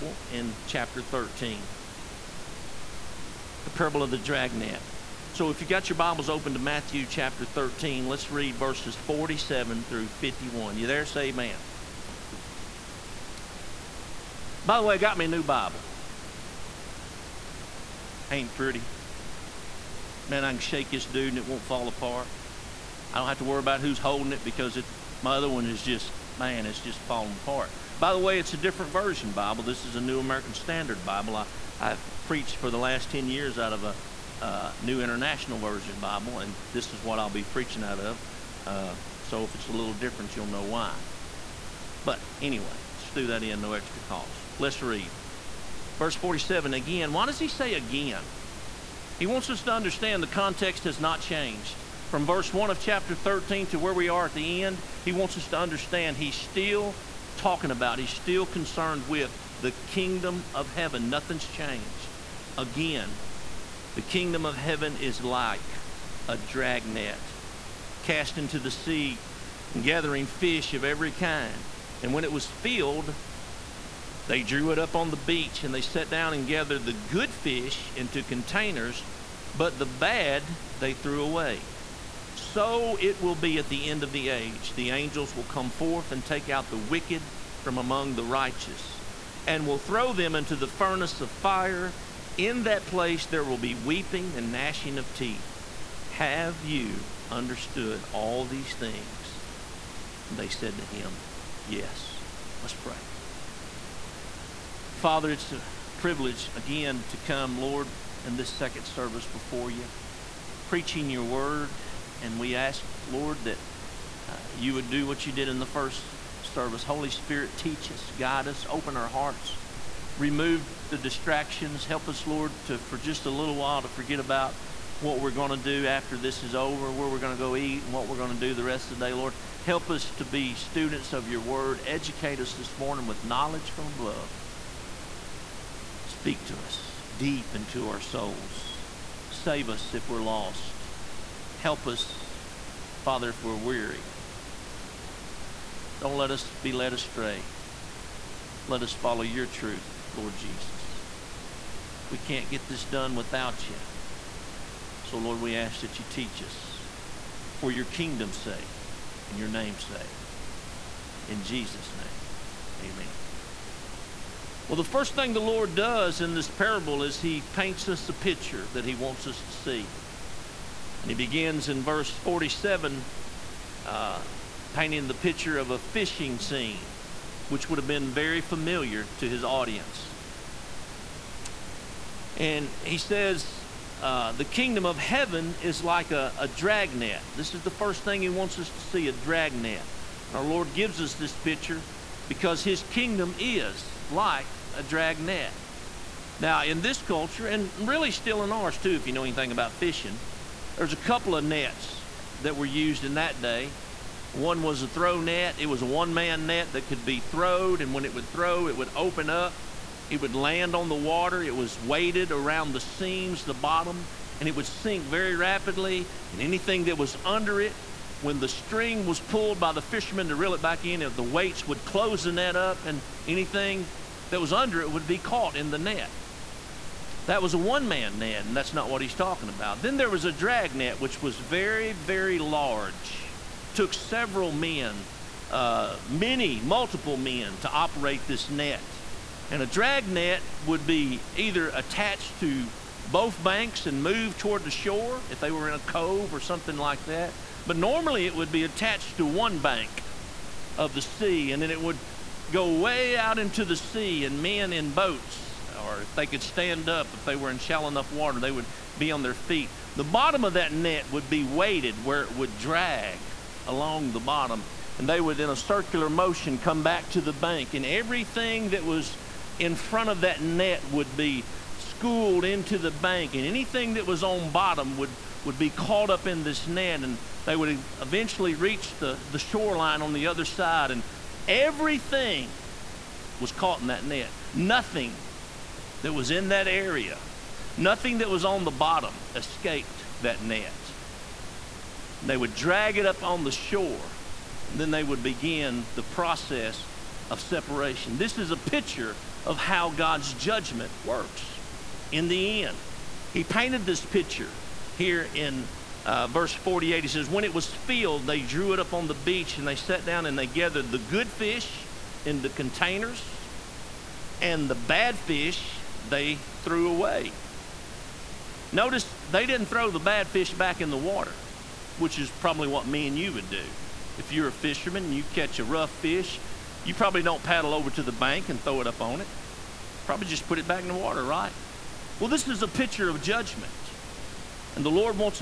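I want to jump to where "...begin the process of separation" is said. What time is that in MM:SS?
04:55.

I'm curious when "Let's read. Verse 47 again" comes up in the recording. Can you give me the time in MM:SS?
00:44.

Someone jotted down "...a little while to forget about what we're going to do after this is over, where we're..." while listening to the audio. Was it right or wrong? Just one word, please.
right.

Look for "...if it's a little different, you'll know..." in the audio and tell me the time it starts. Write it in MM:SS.
00:39.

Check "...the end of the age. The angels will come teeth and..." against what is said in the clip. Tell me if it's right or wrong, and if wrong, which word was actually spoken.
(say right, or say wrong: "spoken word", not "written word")
wrong: "forth", not "teeth".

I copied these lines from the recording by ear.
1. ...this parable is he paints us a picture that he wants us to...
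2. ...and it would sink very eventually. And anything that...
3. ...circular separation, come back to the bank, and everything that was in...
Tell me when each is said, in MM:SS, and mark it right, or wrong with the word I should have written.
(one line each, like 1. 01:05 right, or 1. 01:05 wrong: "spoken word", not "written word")
1. 02:46 right
2. 03:34 wrong: "rapidly", not "eventually"
3. 04:25 wrong: "motion", not "separation".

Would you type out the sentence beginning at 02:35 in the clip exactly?
So, Lord, we ask that you teach us for your kingdom's sake and your name's sake.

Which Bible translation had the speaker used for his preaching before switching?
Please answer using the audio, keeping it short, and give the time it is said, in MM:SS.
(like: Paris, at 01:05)
New International Version, at 00:34.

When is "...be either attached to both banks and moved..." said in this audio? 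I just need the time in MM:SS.
04:00.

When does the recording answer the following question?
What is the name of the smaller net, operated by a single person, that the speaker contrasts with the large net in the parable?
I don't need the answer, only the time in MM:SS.
03:24.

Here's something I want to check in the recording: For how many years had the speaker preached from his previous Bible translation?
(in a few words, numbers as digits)
10.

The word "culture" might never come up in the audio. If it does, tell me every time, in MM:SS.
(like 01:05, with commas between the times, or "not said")
03:17.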